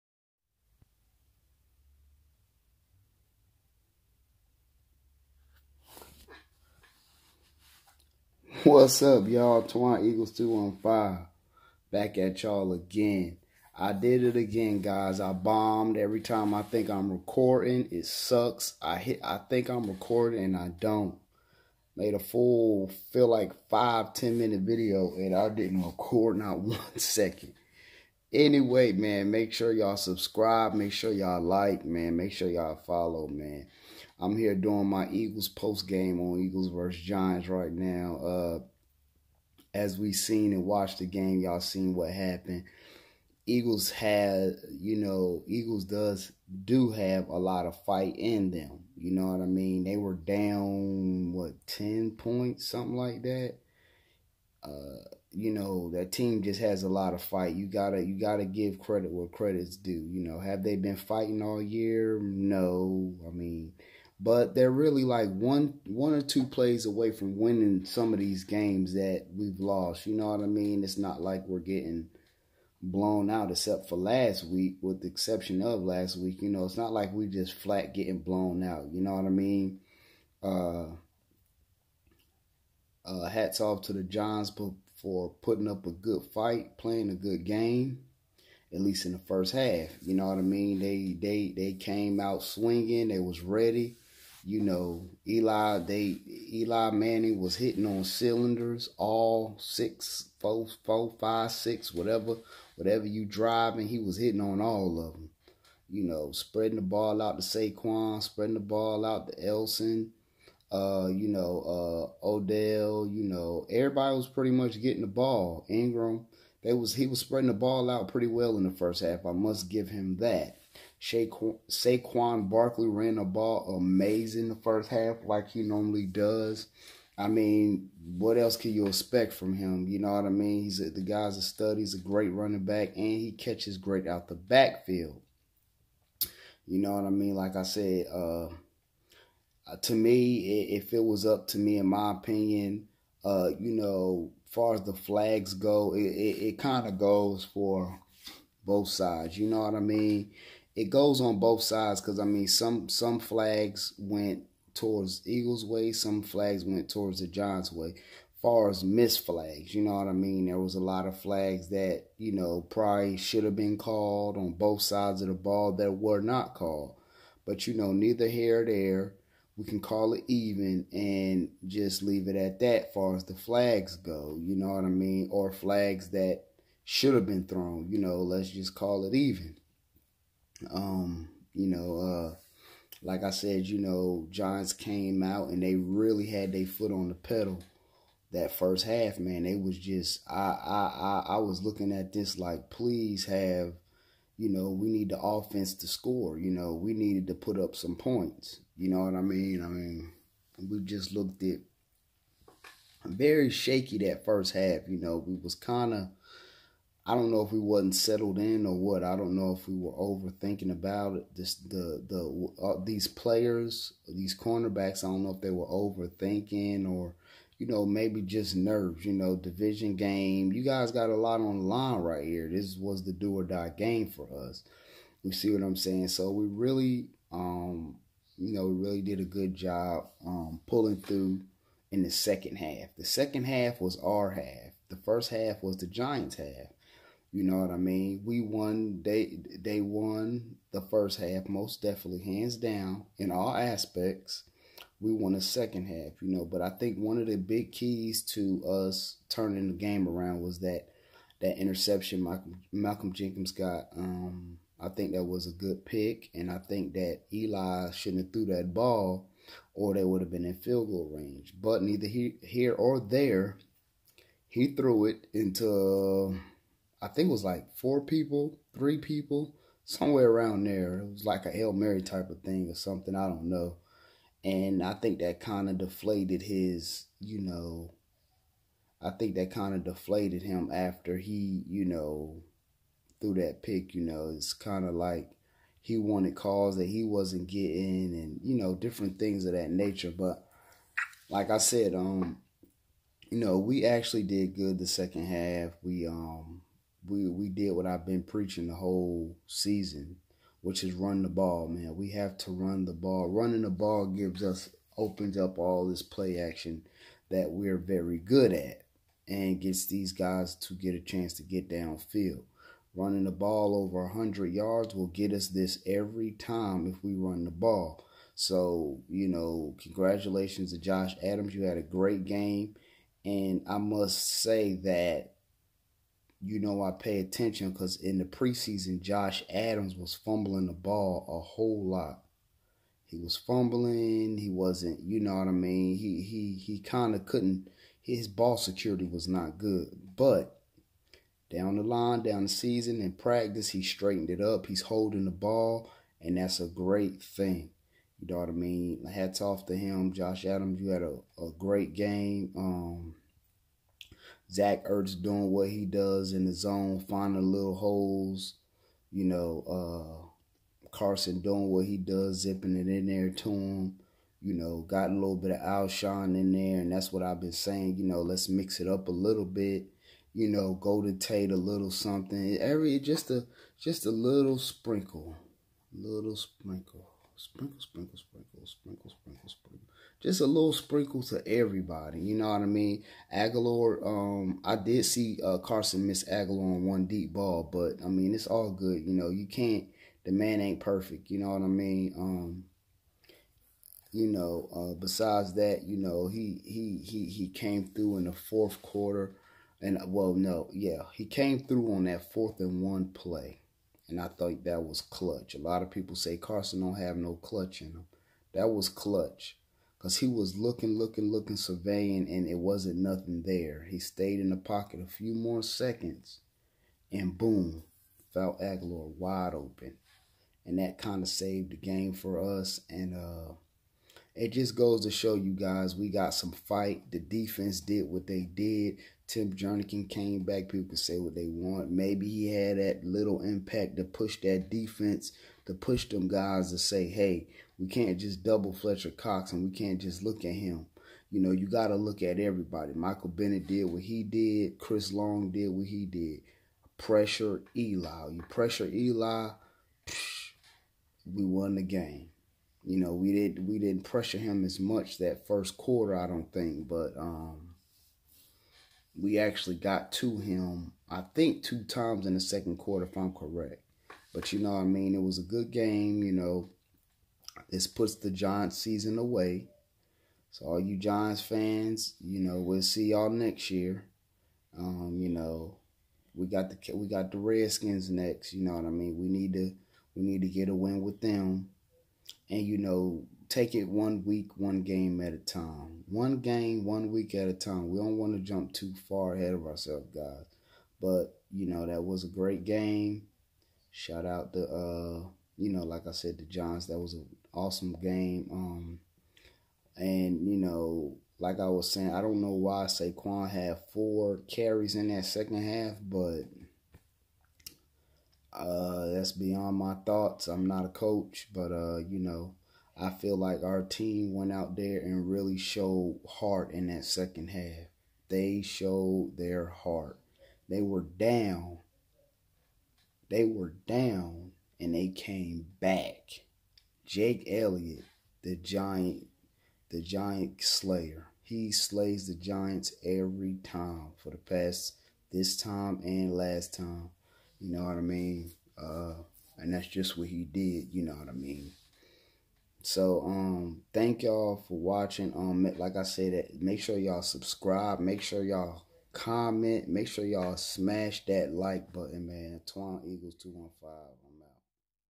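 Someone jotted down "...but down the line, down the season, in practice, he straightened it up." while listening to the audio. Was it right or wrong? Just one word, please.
right.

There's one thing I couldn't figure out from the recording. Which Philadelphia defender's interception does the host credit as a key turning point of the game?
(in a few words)
Malcolm Jenkins.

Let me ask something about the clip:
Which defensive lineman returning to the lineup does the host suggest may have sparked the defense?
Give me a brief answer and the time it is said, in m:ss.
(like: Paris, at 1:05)
Tim Jernigan, at 7:09.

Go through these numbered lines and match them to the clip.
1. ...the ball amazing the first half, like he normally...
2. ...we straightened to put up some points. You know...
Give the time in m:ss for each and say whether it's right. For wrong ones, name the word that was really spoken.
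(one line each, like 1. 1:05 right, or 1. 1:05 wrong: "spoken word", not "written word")
1. 2:03 right
2. 3:16 wrong: "needed", not "straightened".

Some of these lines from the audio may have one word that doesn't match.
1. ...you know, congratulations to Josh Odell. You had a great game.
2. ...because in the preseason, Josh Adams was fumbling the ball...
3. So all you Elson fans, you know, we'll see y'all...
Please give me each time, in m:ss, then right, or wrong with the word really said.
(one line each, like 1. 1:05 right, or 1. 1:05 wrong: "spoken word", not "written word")
1. 5:19 wrong: "Adams", not "Odell"
2. 5:27 right
3. 7:50 wrong: "Giants", not "Elson".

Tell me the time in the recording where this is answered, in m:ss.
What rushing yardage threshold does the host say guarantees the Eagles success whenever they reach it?
5:14.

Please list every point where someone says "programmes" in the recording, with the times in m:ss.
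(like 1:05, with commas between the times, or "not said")
not said.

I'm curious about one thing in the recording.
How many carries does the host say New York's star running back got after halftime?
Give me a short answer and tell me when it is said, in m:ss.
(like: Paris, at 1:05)
4, at 8:23.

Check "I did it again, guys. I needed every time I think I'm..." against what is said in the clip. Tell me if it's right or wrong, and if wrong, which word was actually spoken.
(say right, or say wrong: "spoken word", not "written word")
wrong: "bombed", not "needed".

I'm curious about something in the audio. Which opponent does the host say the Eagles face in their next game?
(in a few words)
Redskins.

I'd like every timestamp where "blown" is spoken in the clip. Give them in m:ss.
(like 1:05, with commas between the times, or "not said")
1:12, 1:18.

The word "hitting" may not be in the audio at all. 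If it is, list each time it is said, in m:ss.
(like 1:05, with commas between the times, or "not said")
1:37, 1:44.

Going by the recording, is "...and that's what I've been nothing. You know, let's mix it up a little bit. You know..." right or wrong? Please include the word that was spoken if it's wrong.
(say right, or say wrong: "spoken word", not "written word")
wrong: "saying", not "nothing".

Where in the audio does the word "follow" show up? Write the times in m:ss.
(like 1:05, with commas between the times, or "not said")
0:32.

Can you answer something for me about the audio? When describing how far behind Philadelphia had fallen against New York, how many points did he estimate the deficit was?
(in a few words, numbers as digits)
10.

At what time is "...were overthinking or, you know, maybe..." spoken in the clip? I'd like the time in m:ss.
3:35.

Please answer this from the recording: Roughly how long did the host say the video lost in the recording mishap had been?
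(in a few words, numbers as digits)
5 to 10 minutes.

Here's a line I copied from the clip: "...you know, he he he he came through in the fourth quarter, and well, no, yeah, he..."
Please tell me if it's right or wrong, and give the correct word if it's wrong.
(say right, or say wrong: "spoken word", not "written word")
right.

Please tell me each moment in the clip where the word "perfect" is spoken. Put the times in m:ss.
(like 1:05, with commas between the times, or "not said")
6:30.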